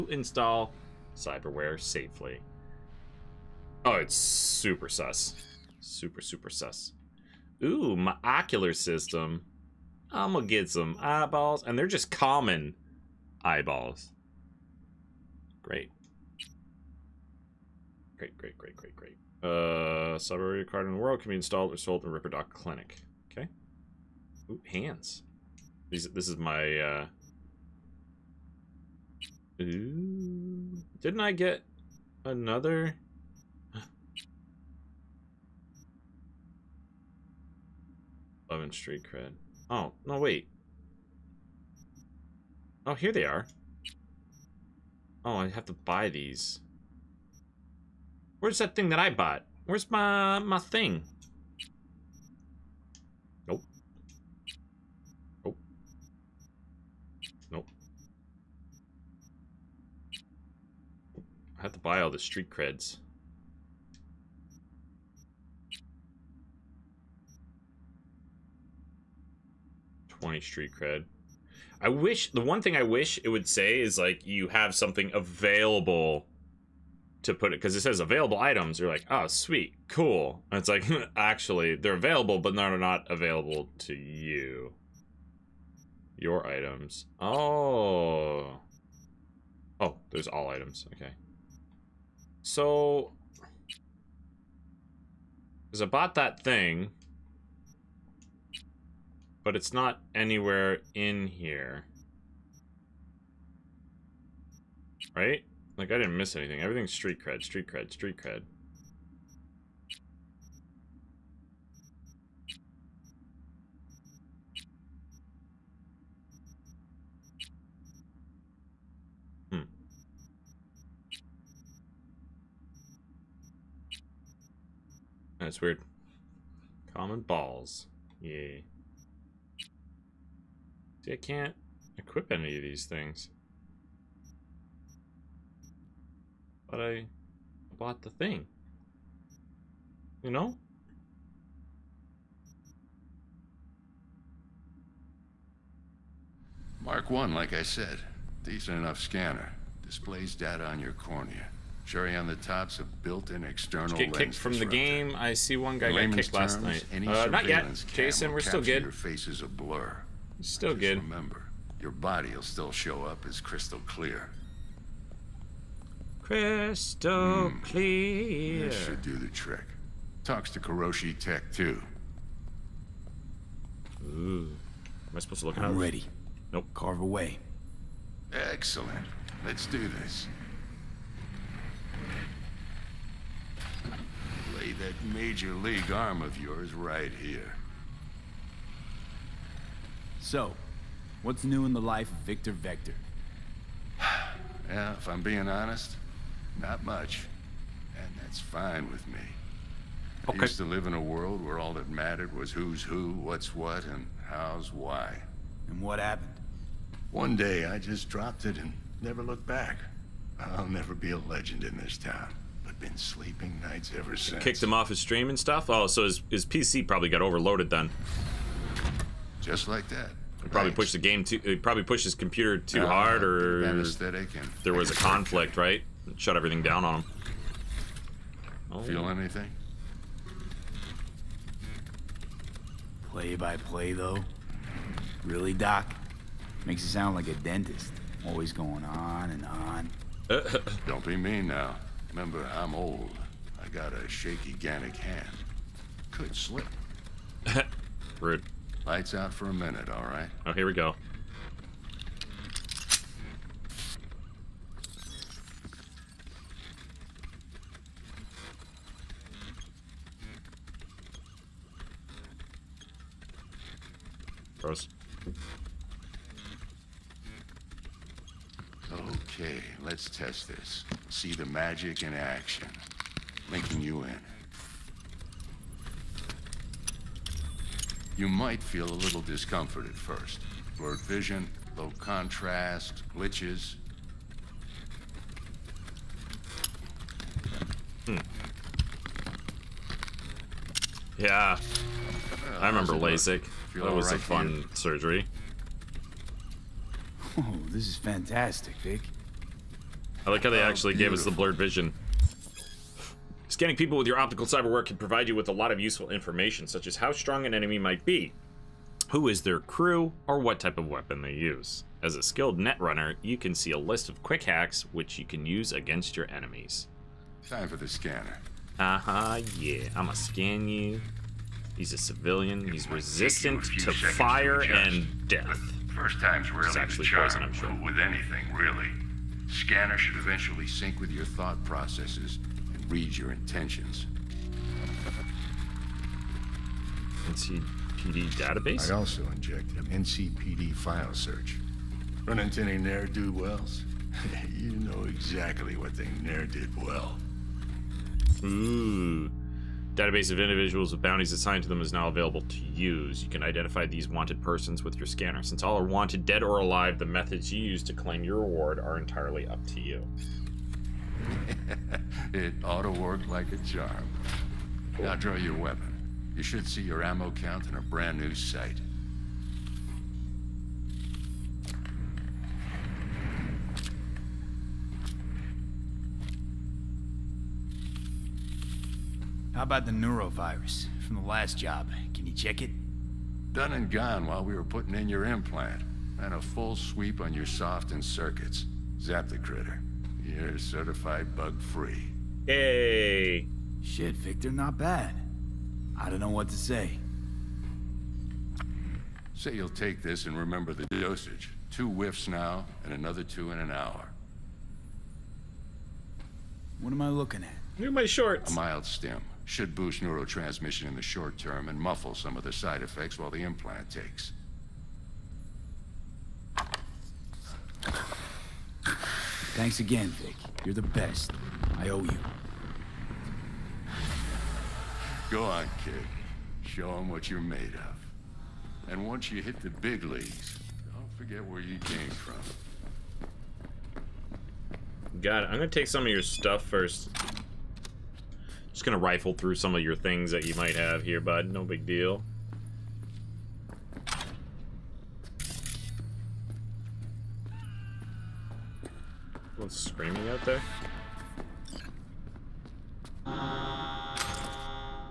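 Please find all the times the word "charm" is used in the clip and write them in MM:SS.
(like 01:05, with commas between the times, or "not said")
05:27, 06:03.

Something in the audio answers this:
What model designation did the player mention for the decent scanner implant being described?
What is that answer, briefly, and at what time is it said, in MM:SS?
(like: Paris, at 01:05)
Mark 1, at 02:26.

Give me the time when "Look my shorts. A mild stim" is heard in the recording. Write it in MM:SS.
06:47.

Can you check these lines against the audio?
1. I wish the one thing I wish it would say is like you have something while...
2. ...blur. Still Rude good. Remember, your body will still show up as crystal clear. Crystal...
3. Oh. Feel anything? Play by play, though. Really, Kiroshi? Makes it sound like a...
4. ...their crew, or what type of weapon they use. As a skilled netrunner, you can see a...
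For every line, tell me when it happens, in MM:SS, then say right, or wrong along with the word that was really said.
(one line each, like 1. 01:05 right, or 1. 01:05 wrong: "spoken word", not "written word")
1. 01:11 wrong: "available", not "while"
2. 02:39 wrong: "Just", not "Rude"
3. 03:48 wrong: "Doc", not "Kiroshi"
4. 05:09 right.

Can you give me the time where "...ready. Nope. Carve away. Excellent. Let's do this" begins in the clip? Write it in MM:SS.
02:55.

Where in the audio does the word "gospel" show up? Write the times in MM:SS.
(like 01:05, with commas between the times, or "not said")
not said.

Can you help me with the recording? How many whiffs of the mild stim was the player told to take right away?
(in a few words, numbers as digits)
2.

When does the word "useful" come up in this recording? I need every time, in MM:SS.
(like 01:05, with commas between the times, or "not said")
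05:05.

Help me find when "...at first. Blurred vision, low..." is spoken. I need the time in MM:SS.
04:39.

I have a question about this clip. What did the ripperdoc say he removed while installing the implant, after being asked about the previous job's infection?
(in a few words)
neurovirus.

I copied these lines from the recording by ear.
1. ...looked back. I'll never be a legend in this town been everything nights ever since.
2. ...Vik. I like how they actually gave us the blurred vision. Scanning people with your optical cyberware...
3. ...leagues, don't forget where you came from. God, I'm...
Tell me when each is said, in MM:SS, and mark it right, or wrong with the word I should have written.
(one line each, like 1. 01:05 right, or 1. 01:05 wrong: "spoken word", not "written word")
1. 03:29 wrong: "sleeping", not "everything"
2. 04:58 right
3. 07:10 right.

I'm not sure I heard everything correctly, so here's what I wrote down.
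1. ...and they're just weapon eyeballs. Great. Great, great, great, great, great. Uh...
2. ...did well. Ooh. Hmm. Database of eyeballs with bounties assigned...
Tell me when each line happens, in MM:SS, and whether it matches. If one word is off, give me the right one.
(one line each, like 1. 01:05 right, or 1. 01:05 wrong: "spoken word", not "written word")
1. 00:11 wrong: "common", not "weapon"
2. 05:46 wrong: "individuals", not "eyeballs".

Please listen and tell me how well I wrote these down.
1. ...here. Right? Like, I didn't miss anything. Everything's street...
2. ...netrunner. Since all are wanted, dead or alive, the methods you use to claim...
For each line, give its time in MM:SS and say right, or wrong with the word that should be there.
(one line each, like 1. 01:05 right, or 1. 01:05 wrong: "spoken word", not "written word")
1. 01:41 right
2. 05:55 wrong: "scanner", not "netrunner".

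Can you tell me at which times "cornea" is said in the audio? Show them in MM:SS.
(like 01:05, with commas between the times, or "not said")
02:30.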